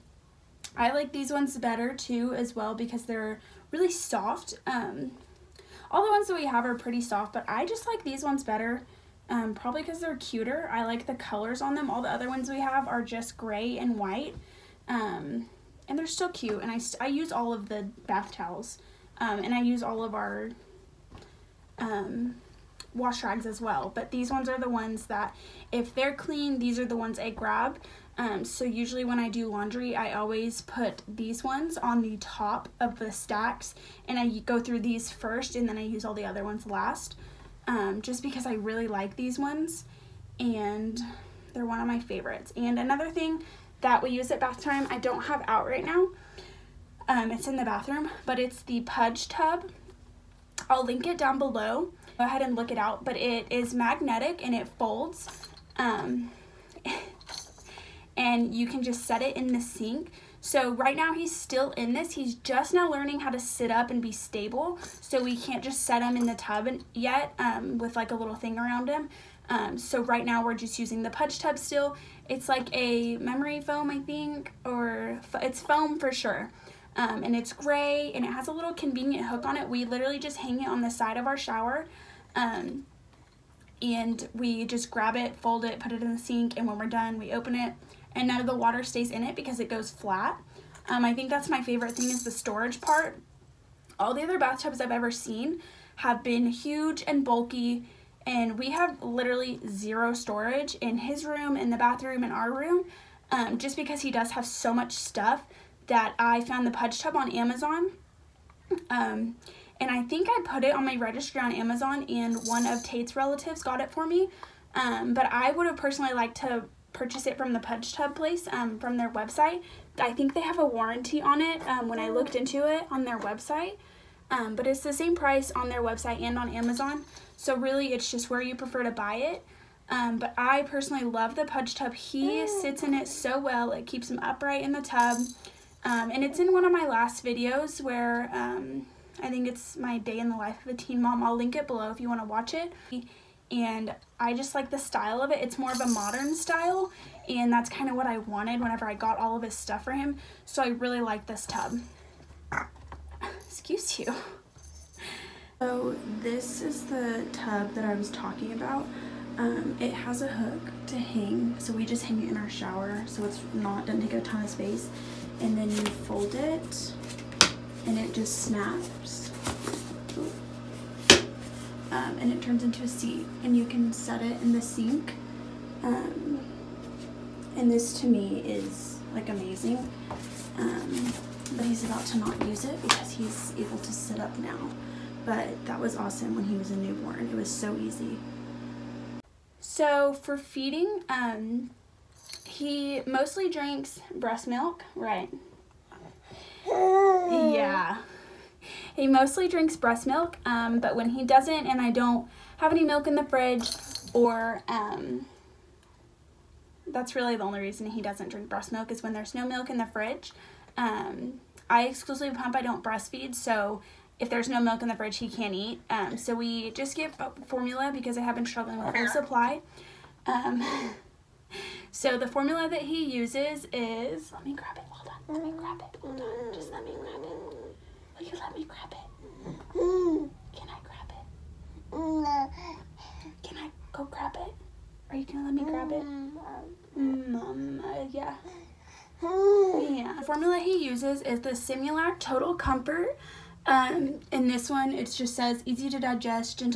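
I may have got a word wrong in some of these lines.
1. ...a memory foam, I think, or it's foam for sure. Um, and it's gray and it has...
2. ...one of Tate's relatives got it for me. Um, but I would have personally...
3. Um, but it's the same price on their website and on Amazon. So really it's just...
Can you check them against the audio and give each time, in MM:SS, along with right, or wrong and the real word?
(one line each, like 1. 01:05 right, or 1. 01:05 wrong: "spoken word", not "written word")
1. 01:12 right
2. 01:52 right
3. 02:04 right.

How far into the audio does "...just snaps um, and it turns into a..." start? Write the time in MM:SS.
02:48.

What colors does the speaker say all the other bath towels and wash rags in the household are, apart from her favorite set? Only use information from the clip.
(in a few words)
gray and white.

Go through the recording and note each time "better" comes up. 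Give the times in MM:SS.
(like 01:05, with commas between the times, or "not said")
00:01, 00:08.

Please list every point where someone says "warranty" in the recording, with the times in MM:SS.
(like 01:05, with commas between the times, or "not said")
02:00.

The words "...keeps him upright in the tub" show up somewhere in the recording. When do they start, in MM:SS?
02:13.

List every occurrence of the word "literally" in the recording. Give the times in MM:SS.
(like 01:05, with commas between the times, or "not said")
01:19, 01:39.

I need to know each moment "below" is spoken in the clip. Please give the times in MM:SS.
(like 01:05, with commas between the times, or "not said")
00:51, 02:21.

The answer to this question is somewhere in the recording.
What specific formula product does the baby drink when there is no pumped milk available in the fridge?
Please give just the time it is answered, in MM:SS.
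04:01.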